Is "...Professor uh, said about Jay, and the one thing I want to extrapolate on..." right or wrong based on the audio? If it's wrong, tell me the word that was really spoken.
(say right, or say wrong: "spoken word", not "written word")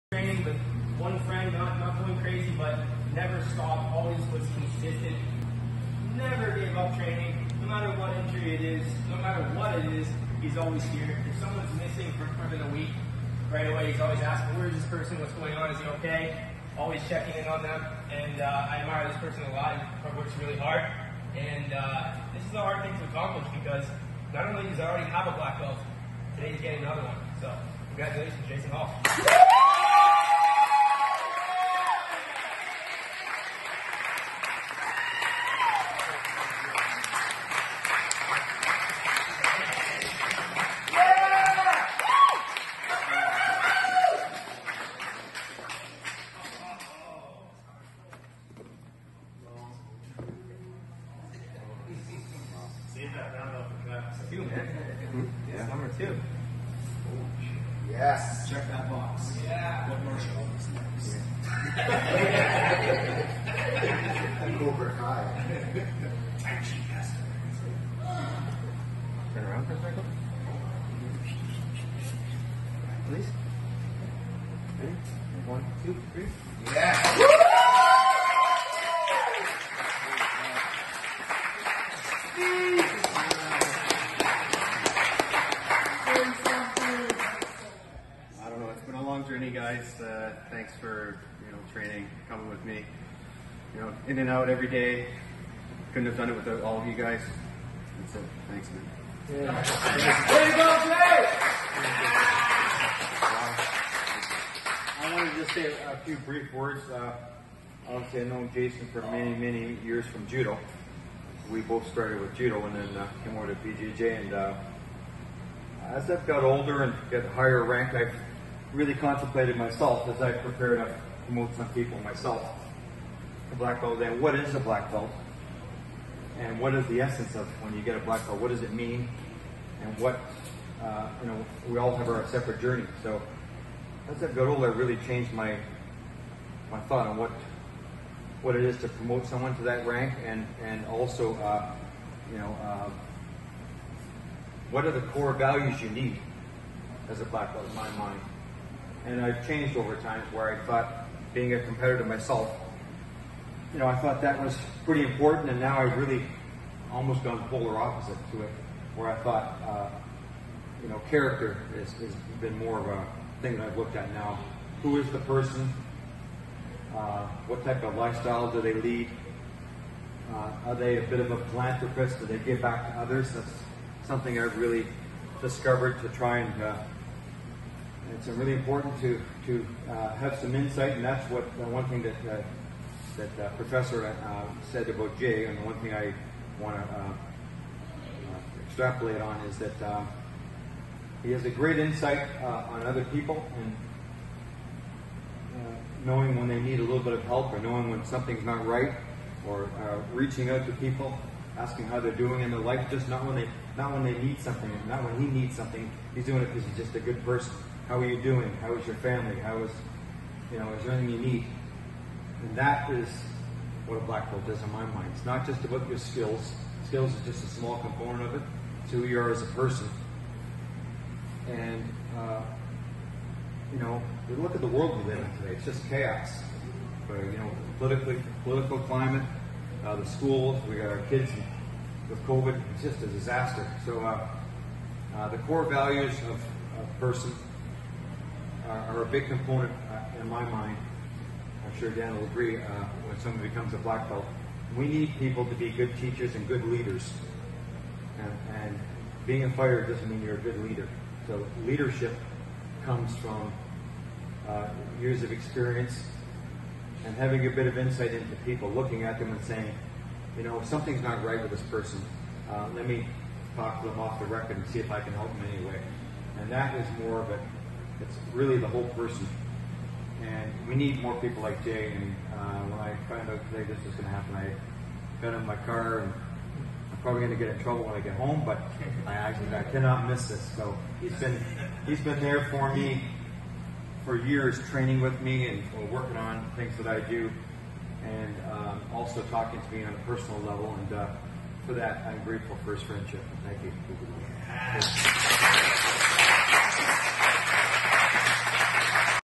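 right.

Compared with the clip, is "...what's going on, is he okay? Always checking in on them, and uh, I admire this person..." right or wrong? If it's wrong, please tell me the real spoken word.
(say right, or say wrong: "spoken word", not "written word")
right.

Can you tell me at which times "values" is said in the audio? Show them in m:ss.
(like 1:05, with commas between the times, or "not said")
2:25, 3:55.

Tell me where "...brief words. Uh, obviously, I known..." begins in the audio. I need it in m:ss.
1:46.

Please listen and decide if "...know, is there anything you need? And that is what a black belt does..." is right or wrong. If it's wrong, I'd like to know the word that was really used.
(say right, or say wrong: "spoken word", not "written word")
right.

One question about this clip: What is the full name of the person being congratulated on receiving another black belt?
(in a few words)
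Jason Hall.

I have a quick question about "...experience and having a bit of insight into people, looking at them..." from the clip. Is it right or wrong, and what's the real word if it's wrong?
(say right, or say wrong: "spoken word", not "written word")
right.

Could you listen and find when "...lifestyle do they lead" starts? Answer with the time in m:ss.
2:47.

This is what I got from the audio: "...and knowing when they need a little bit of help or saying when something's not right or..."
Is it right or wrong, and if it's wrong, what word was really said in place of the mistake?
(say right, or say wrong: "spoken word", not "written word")
wrong: "knowing", not "saying".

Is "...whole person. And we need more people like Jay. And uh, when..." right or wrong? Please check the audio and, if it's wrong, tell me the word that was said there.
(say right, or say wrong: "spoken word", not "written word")
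right.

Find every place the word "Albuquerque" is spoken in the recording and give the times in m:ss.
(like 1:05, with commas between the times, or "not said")
not said.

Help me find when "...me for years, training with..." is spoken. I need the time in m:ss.
4:42.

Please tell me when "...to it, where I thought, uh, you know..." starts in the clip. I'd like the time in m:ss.
2:38.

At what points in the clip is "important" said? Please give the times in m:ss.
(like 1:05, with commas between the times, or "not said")
2:35, 2:58.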